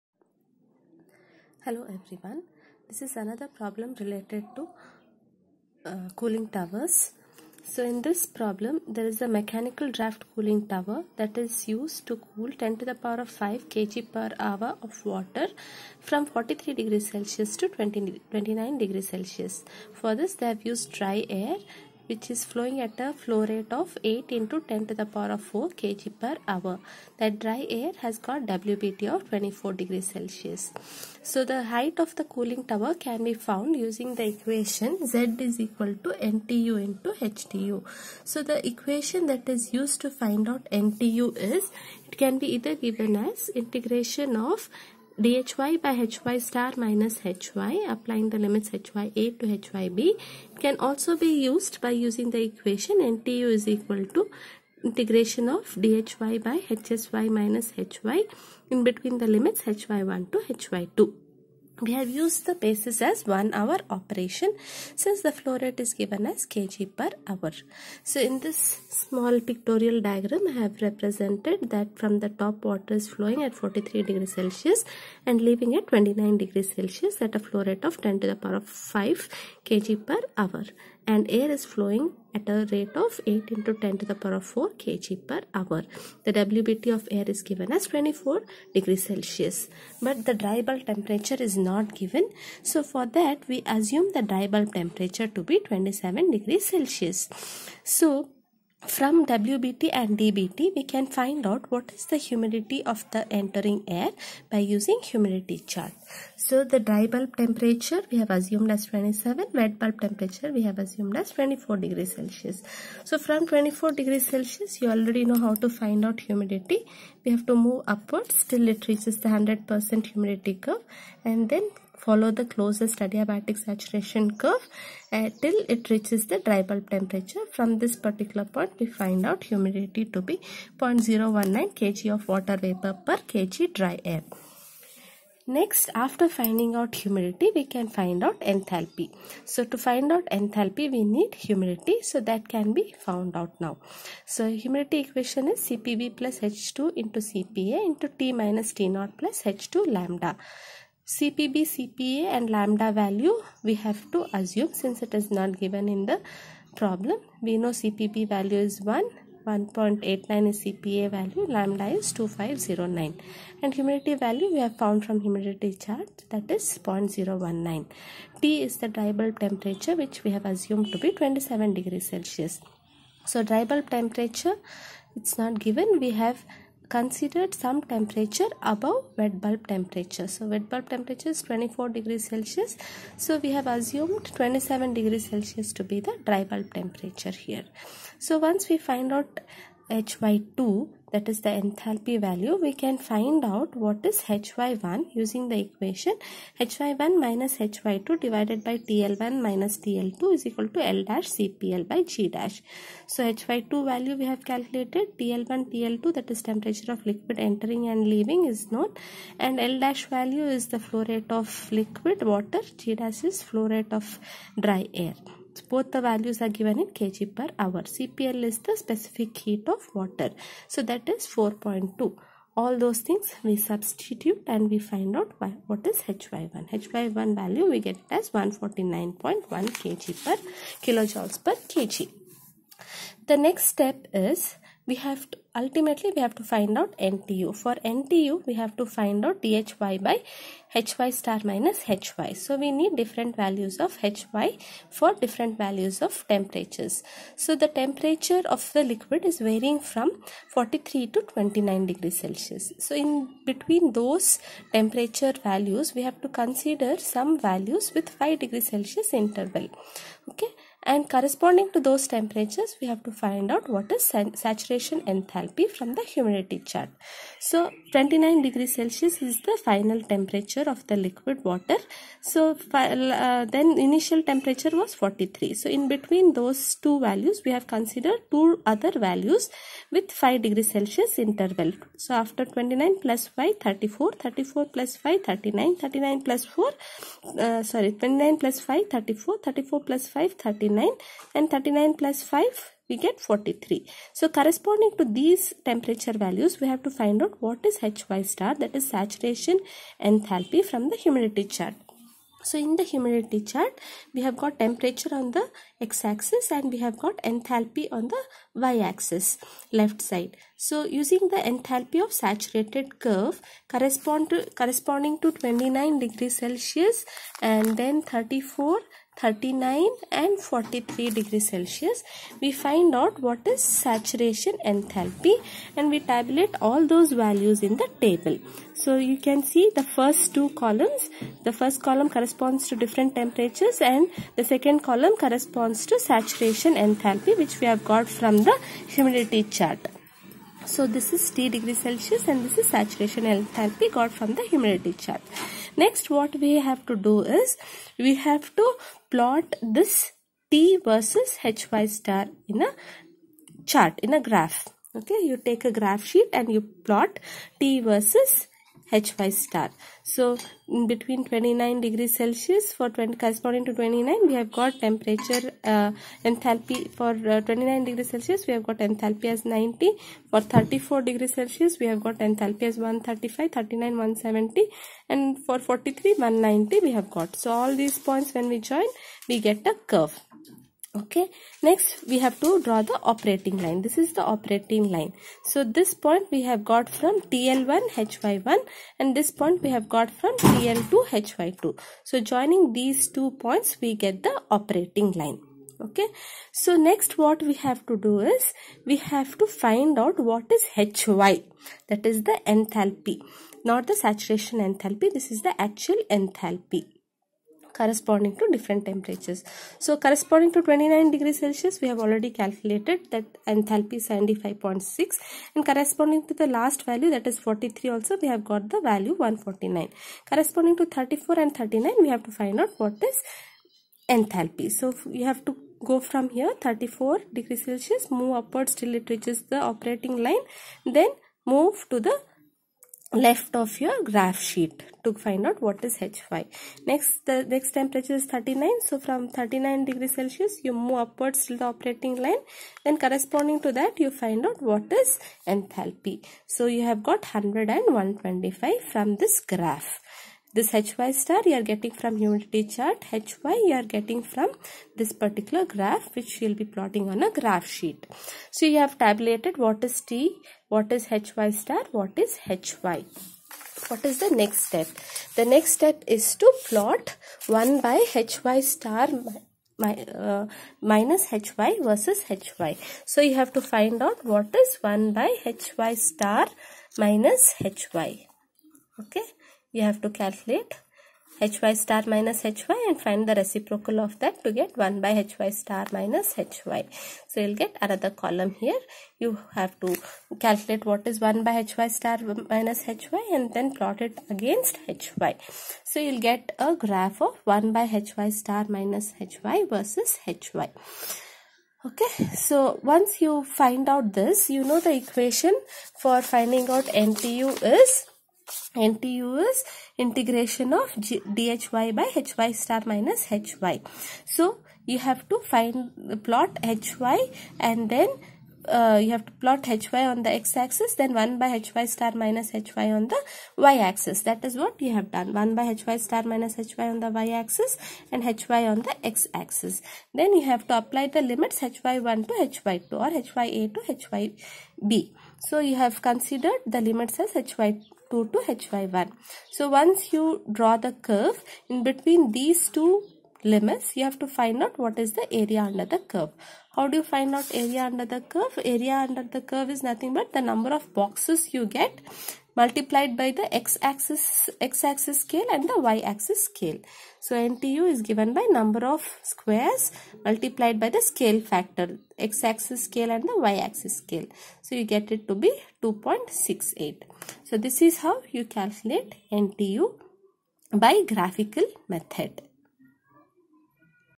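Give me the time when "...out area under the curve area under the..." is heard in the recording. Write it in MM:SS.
09:07.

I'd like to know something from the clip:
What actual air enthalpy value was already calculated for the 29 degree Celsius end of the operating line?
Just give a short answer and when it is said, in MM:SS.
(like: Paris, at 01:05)
75.6, at 06:54.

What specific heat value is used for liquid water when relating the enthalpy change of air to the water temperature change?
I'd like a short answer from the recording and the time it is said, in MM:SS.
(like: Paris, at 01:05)
4.2, at 03:41.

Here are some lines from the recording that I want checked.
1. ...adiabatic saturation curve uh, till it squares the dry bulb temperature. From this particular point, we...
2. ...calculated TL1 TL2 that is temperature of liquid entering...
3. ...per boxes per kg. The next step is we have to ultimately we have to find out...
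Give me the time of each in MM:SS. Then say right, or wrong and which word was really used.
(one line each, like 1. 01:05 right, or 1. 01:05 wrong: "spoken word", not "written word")
1. 02:03 wrong: "reaches", not "squares"
2. 03:24 right
3. 03:50 wrong: "kilojoules", not "boxes".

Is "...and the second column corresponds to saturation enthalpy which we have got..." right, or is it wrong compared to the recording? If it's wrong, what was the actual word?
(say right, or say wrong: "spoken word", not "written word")
right.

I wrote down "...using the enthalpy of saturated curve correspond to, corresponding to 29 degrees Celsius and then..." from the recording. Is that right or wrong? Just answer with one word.
right.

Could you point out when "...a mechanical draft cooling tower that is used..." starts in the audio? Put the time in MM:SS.
00:09.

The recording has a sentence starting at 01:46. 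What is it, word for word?
So the dry bulb temperature we have assumed as 27, wet bulb temperature we have assumed as 24 degrees Celsius.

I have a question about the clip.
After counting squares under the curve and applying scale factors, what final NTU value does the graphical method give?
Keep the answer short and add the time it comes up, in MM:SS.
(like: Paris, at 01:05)
2.68, at 09:25.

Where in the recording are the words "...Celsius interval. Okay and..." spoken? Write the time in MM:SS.
04:18.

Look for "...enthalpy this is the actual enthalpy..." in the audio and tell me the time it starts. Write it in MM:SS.
06:44.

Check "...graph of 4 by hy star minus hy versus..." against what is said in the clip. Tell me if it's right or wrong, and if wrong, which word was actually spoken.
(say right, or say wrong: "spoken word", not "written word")
wrong: "1", not "4".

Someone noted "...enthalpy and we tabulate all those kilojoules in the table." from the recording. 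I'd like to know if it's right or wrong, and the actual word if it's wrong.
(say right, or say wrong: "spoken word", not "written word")
wrong: "values", not "kilojoules".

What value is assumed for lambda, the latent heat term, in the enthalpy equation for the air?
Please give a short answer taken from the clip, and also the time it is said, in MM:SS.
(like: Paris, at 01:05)
2509, at 02:42.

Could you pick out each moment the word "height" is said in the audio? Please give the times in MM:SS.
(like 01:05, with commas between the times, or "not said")
00:31.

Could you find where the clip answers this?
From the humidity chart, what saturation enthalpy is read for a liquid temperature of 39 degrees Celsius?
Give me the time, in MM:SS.
06:13.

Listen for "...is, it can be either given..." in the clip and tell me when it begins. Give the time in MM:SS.
00:41.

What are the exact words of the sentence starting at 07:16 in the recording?
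Next, the next temperature is 39.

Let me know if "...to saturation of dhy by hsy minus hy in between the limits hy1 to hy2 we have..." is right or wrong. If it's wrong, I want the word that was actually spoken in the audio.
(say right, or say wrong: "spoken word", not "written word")
wrong: "integration", not "saturation".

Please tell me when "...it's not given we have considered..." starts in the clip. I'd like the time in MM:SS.
02:55.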